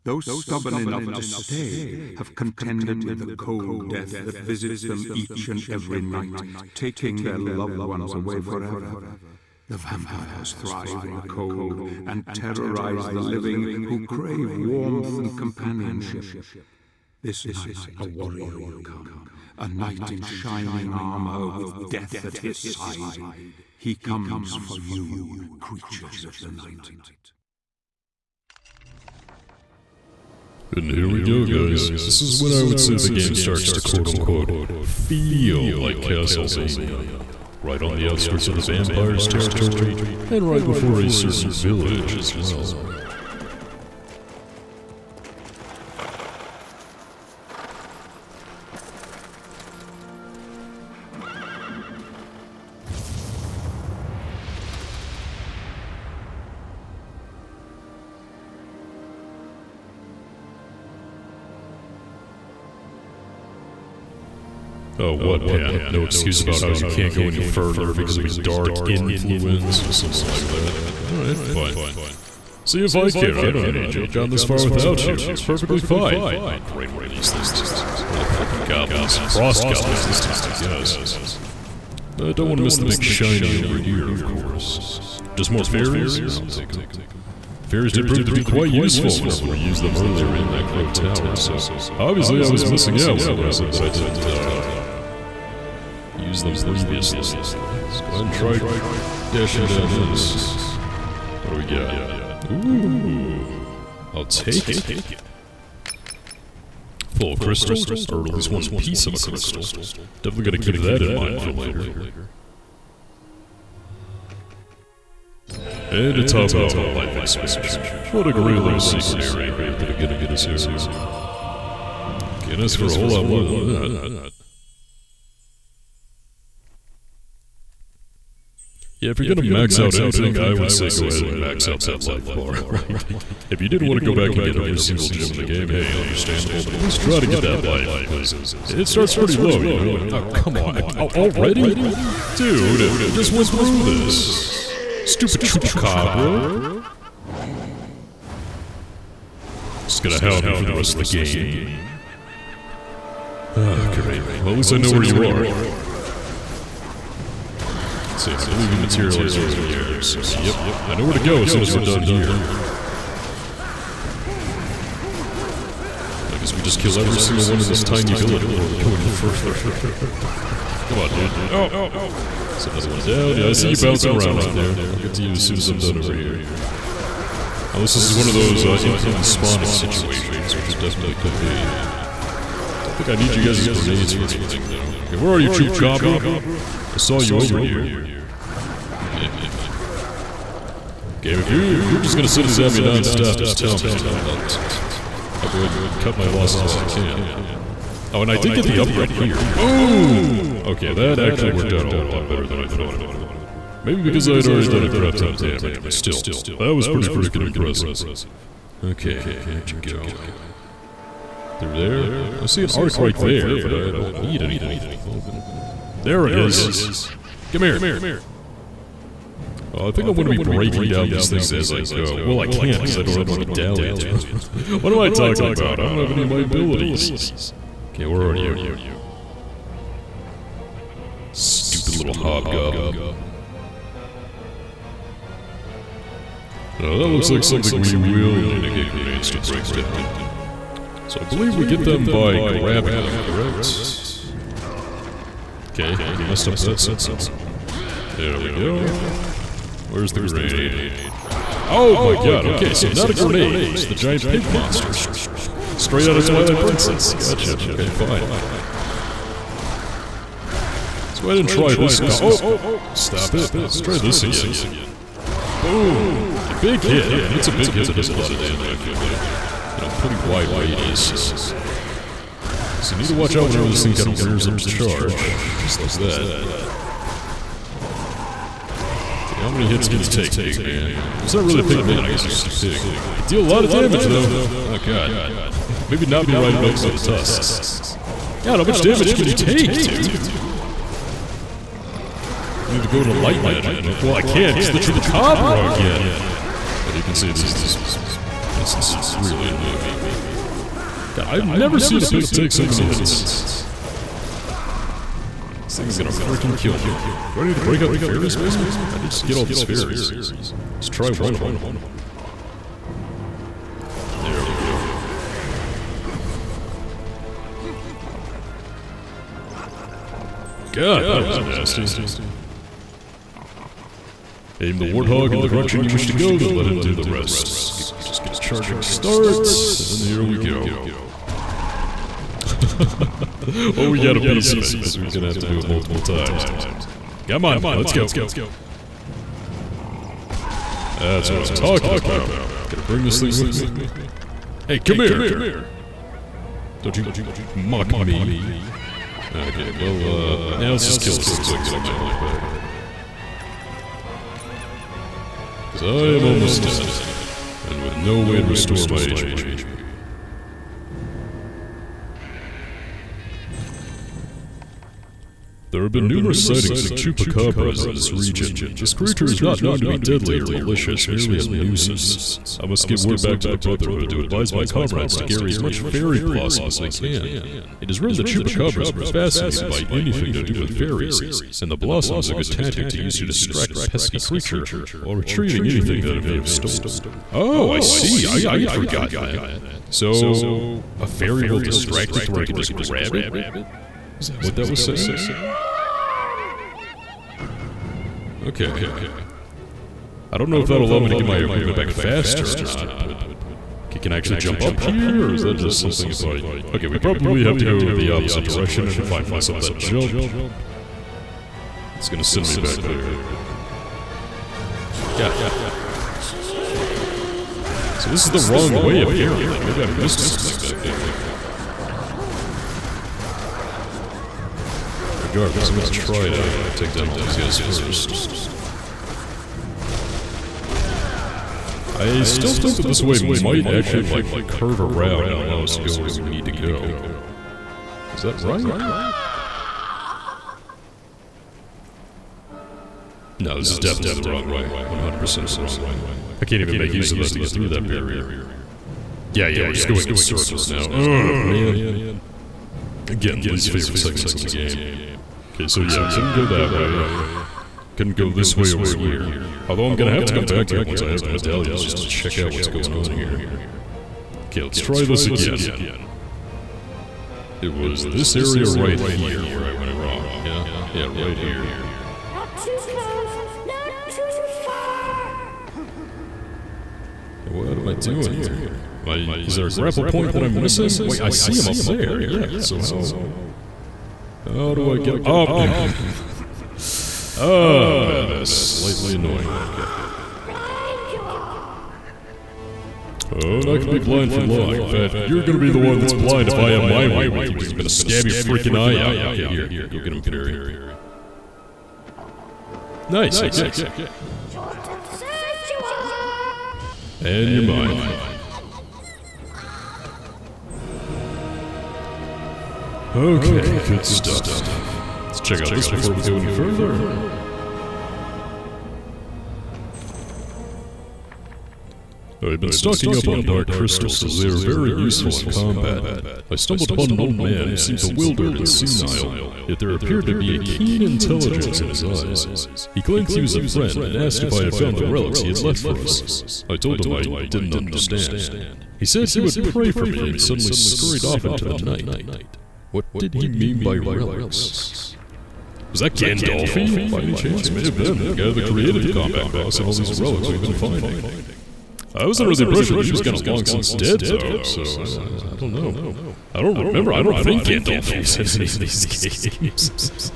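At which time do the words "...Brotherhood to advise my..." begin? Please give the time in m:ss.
6:13.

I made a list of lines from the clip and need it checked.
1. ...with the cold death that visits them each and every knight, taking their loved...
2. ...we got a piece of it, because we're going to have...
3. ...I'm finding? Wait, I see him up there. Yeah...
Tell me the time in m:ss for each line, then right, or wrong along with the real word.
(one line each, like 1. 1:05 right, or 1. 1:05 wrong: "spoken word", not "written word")
1. 0:03 wrong: "night", not "knight"
2. 5:33 right
3. 8:00 wrong: "missing", not "finding".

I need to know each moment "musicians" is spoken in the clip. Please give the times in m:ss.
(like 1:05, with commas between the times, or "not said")
not said.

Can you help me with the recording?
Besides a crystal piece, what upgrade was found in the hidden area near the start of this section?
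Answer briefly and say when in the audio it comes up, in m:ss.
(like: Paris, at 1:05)
Life expansion, at 1:56.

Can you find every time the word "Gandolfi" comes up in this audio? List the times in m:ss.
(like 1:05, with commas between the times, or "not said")
9:06, 9:17.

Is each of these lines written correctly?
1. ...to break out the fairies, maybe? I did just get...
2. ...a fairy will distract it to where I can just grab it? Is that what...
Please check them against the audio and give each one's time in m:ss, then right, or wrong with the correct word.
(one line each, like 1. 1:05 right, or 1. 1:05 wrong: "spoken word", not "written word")
1. 5:07 right
2. 6:30 right.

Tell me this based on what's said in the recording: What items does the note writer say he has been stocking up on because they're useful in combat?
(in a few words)
Dark crystals.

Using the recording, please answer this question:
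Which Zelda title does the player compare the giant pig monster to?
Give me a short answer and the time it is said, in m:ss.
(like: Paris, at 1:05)
Twilight Princess, at 4:16.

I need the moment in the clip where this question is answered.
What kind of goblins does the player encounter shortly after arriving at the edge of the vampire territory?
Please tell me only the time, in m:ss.
1:19.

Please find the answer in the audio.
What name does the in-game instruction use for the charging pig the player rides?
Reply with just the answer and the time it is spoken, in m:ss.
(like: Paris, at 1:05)
Warthog, at 5:24.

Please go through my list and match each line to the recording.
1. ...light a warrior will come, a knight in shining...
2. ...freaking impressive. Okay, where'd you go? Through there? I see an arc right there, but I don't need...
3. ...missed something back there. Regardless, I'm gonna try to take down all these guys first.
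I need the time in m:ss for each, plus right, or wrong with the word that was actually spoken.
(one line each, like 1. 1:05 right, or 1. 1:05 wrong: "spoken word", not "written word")
1. 0:17 wrong: "night", not "light"
2. 3:27 right
3. 6:59 right.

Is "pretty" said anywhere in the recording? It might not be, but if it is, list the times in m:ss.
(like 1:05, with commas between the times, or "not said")
2:19, 3:26, 4:29.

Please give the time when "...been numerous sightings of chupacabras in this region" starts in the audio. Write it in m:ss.
6:05.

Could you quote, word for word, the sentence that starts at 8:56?
I told him I didn't understand.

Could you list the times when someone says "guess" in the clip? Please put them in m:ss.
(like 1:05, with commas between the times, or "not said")
1:20, 2:46, 4:42.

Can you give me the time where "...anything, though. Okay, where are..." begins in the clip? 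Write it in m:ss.
3:04.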